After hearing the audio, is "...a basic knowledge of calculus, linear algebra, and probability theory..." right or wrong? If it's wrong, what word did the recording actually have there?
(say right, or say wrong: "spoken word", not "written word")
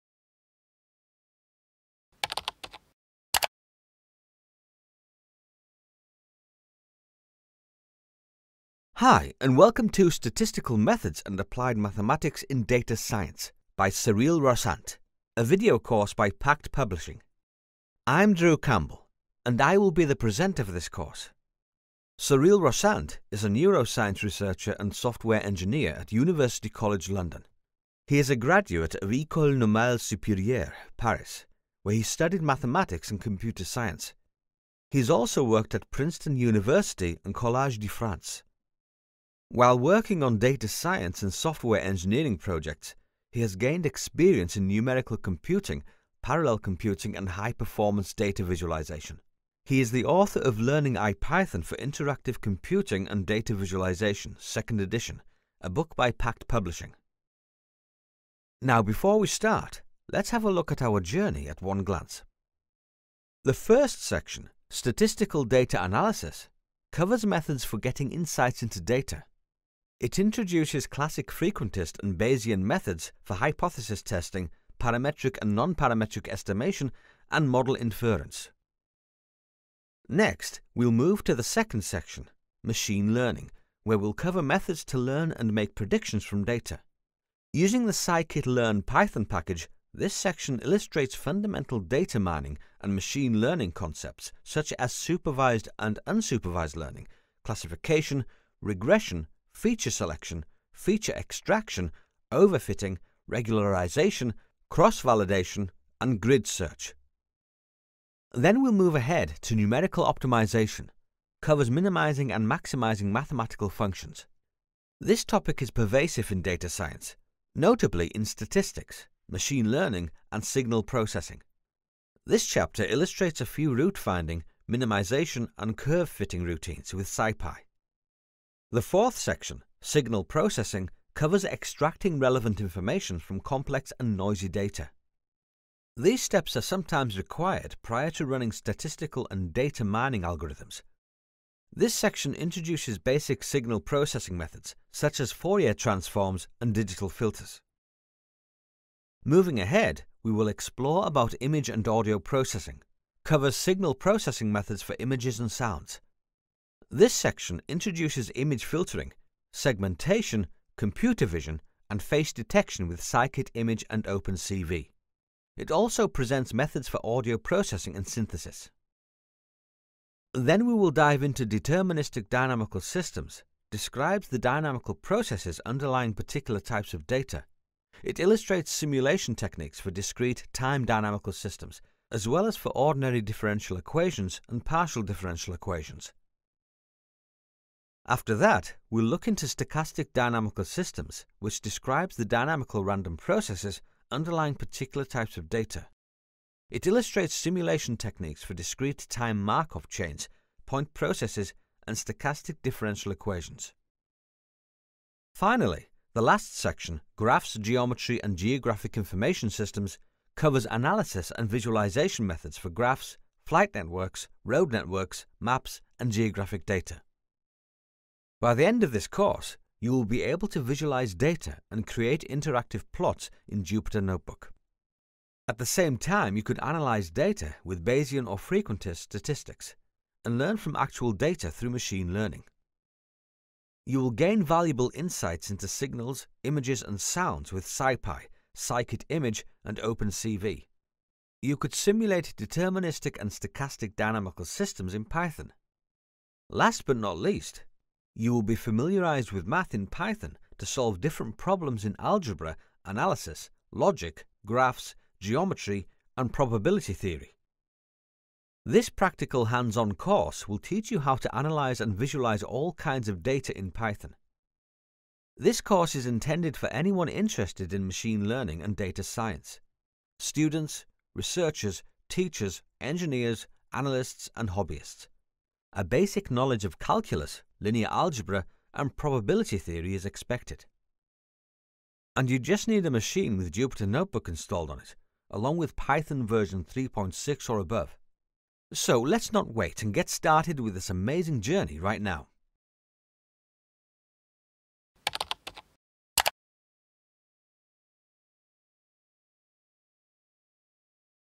right.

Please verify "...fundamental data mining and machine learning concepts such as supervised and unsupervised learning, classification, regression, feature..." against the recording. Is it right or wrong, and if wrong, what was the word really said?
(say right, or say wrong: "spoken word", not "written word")
right.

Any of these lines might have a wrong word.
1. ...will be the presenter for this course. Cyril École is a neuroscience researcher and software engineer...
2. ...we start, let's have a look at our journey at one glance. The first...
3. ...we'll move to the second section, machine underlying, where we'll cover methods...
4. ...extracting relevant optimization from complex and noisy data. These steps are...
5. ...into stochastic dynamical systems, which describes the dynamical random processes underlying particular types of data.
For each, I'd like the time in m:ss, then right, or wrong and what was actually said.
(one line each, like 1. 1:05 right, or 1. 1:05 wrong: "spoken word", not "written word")
1. 0:19 wrong: "Rossant", not "École"
2. 0:59 right
3. 1:20 wrong: "learning", not "underlying"
4. 2:11 wrong: "information", not "optimization"
5. 3:09 right.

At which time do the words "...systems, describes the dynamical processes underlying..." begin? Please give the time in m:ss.
2:52.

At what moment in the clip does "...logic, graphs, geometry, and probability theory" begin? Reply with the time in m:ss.
4:13.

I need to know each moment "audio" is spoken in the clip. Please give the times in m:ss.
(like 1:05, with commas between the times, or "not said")
2:31, 2:47.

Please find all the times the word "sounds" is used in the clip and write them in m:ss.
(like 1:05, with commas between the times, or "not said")
2:35, 3:56.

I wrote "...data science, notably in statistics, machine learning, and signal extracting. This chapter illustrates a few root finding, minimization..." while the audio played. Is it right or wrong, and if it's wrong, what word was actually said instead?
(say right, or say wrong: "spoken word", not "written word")
wrong: "processing", not "extracting".